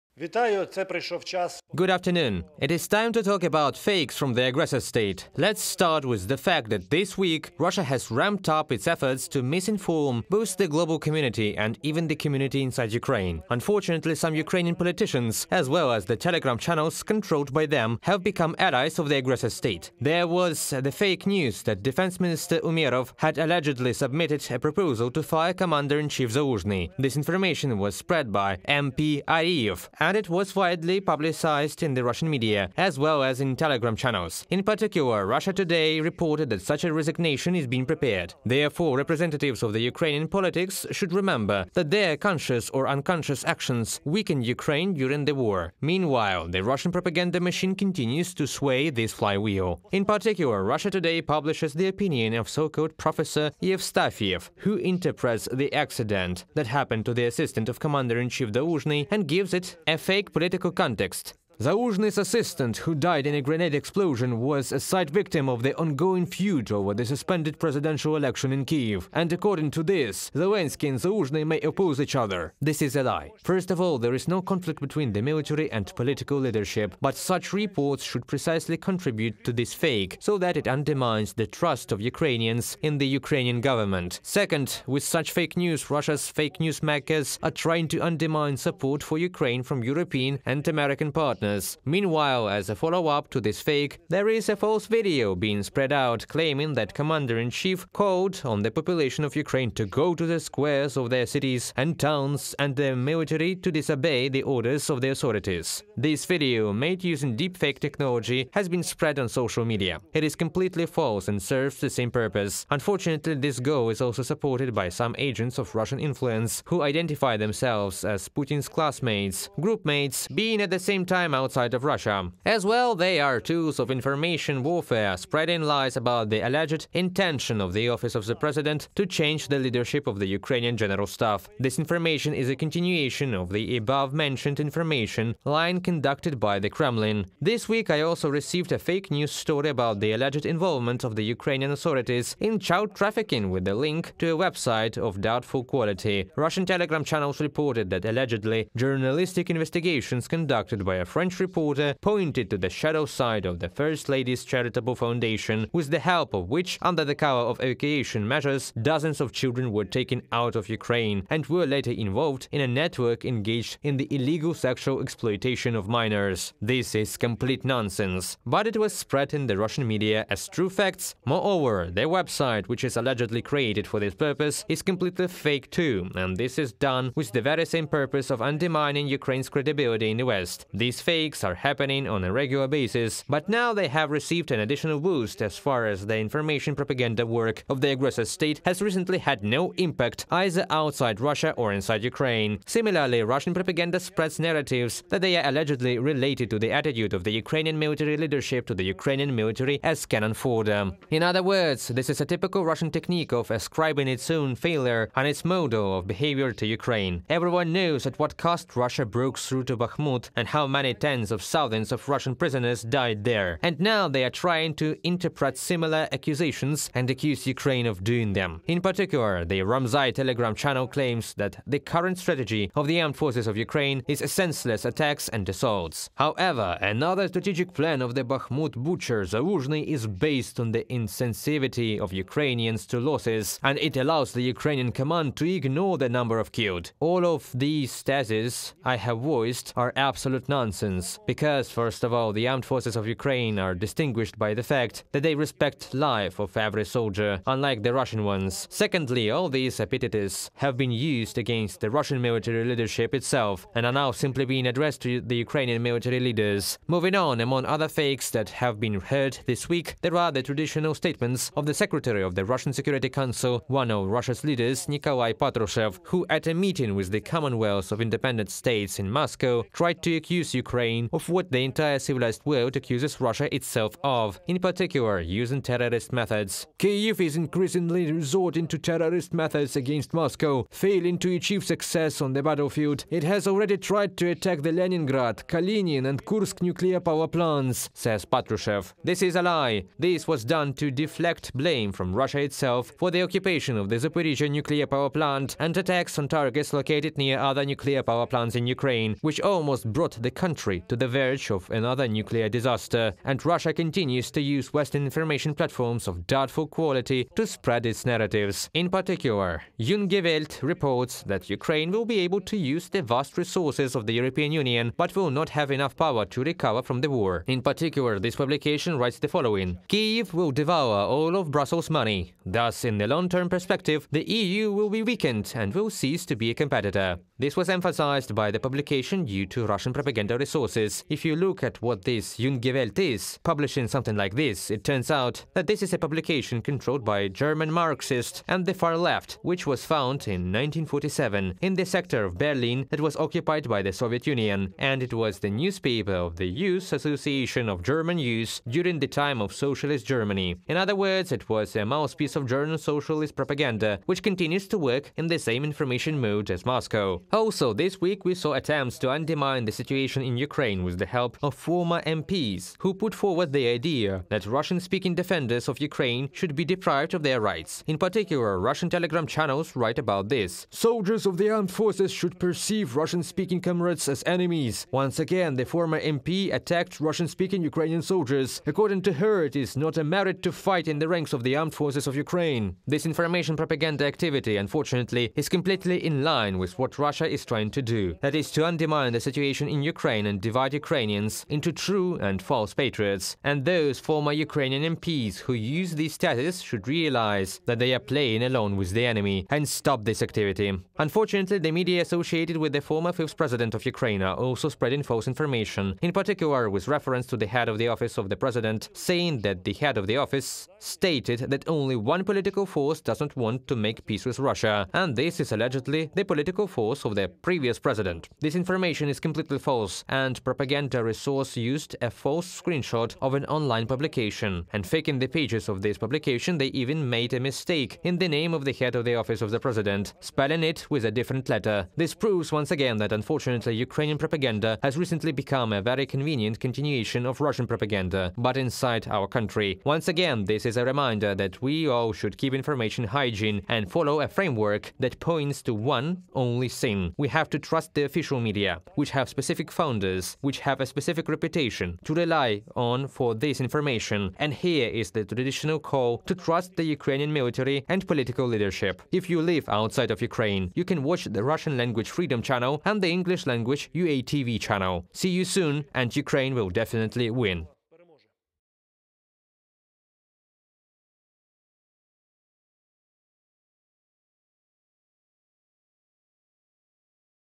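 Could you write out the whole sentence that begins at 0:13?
Unfortunately, some Ukrainian politicians, as well as the telegram channels controlled by them, have become allies of the aggressor state.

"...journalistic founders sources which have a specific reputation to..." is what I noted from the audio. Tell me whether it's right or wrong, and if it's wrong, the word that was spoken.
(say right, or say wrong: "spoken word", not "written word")
wrong: "specific", not "journalistic".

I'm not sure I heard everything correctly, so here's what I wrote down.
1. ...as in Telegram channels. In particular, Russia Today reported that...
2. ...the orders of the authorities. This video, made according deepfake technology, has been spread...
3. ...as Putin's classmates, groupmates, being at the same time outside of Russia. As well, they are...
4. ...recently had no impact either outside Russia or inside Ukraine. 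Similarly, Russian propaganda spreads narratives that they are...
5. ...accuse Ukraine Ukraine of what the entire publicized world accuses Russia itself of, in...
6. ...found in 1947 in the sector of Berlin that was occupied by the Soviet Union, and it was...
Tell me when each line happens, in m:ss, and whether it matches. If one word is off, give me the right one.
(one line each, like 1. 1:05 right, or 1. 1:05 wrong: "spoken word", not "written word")
1. 0:33 right
2. 1:44 wrong: "using", not "according"
3. 1:58 right
4. 3:08 right
5. 4:30 wrong: "civilized", not "publicized"
6. 5:39 right.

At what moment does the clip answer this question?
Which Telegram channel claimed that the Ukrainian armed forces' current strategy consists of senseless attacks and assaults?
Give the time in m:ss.
3:39.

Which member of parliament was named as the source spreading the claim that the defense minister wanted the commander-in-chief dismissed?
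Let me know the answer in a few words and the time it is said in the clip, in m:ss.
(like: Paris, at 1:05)
Ariyev, at 0:29.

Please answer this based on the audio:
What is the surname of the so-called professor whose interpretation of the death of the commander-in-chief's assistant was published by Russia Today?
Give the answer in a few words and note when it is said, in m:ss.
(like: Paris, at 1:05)
Yevstafiev, at 0:53.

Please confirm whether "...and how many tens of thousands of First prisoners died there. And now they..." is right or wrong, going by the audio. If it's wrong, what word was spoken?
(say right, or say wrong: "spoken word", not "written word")
wrong: "Russian", not "First".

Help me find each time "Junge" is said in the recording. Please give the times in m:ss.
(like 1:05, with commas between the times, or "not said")
5:09, 5:32.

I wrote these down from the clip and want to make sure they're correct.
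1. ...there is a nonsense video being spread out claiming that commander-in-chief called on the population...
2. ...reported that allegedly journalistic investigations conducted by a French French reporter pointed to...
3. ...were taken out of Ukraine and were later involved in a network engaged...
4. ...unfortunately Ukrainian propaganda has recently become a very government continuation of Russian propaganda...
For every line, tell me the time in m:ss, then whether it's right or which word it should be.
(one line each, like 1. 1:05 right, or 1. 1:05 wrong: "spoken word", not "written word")
1. 1:34 wrong: "false", not "nonsense"
2. 2:27 right
3. 2:39 right
4. 7:13 wrong: "convenient", not "government".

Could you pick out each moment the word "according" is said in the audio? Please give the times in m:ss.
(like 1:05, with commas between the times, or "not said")
1:09, 6:18.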